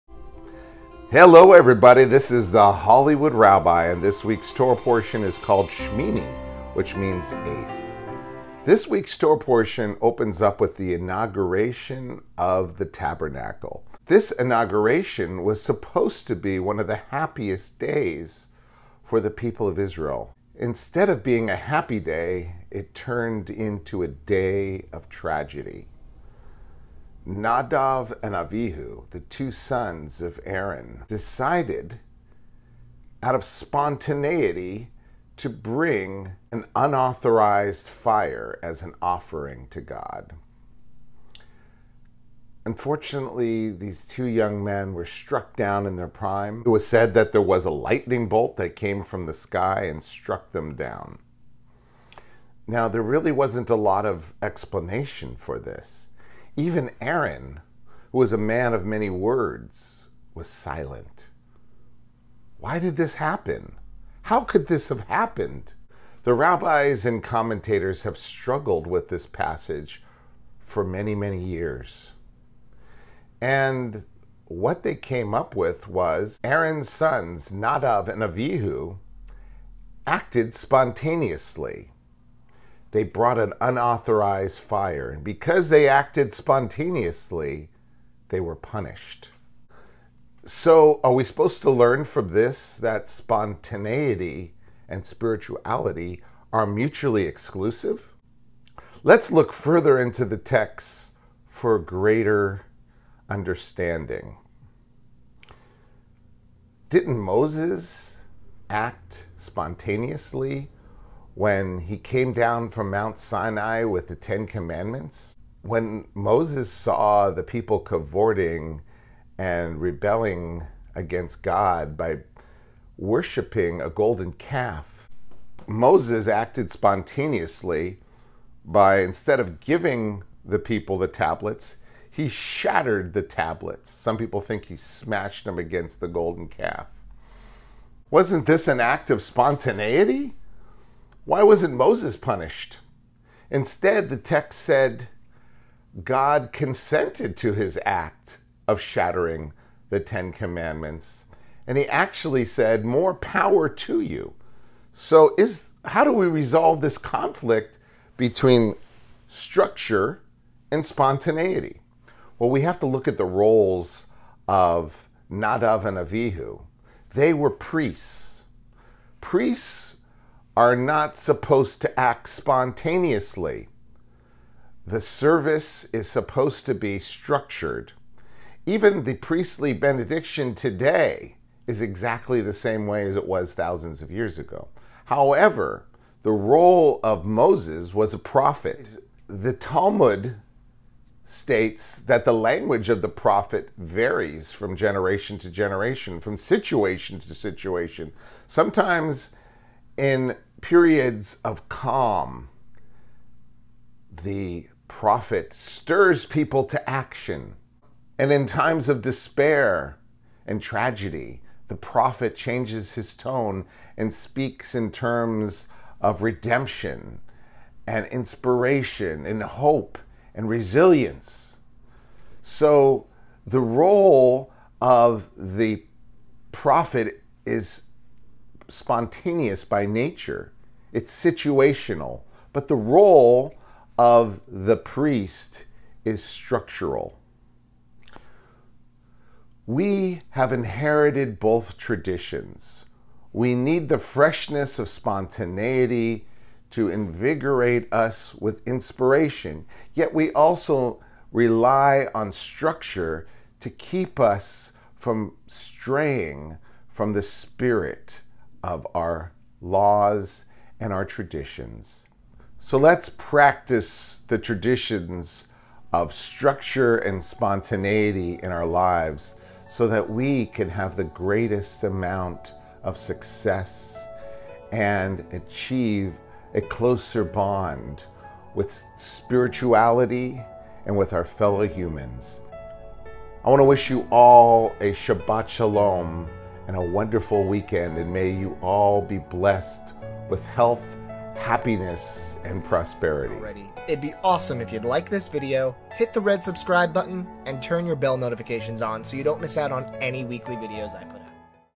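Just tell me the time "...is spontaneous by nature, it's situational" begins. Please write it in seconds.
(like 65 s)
227 s.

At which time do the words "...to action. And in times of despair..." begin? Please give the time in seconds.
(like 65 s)
206 s.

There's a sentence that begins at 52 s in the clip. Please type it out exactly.
Now, there really wasn't a lot of explanation for this.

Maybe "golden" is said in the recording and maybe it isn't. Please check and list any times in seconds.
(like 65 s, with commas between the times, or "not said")
123 s, 136 s.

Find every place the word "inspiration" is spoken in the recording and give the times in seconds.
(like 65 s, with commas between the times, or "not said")
218 s, 248 s.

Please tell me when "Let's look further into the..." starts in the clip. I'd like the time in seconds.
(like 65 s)
99 s.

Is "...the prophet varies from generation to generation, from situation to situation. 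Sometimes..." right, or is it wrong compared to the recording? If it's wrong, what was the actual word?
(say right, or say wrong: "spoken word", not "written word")
right.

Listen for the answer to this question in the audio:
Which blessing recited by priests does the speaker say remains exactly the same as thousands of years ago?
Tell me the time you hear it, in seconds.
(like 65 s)
179 s.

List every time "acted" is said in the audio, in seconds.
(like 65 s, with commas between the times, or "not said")
80 s, 85 s, 126 s.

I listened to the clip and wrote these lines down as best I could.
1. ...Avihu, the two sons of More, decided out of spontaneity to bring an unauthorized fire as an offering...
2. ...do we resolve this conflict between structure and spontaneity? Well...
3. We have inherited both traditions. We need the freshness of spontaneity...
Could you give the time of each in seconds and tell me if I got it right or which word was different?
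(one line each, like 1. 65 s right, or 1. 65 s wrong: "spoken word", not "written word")
1. 28 s wrong: "Aaron", not "More"
2. 156 s right
3. 239 s right.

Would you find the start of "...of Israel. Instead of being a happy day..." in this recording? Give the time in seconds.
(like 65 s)
19 s.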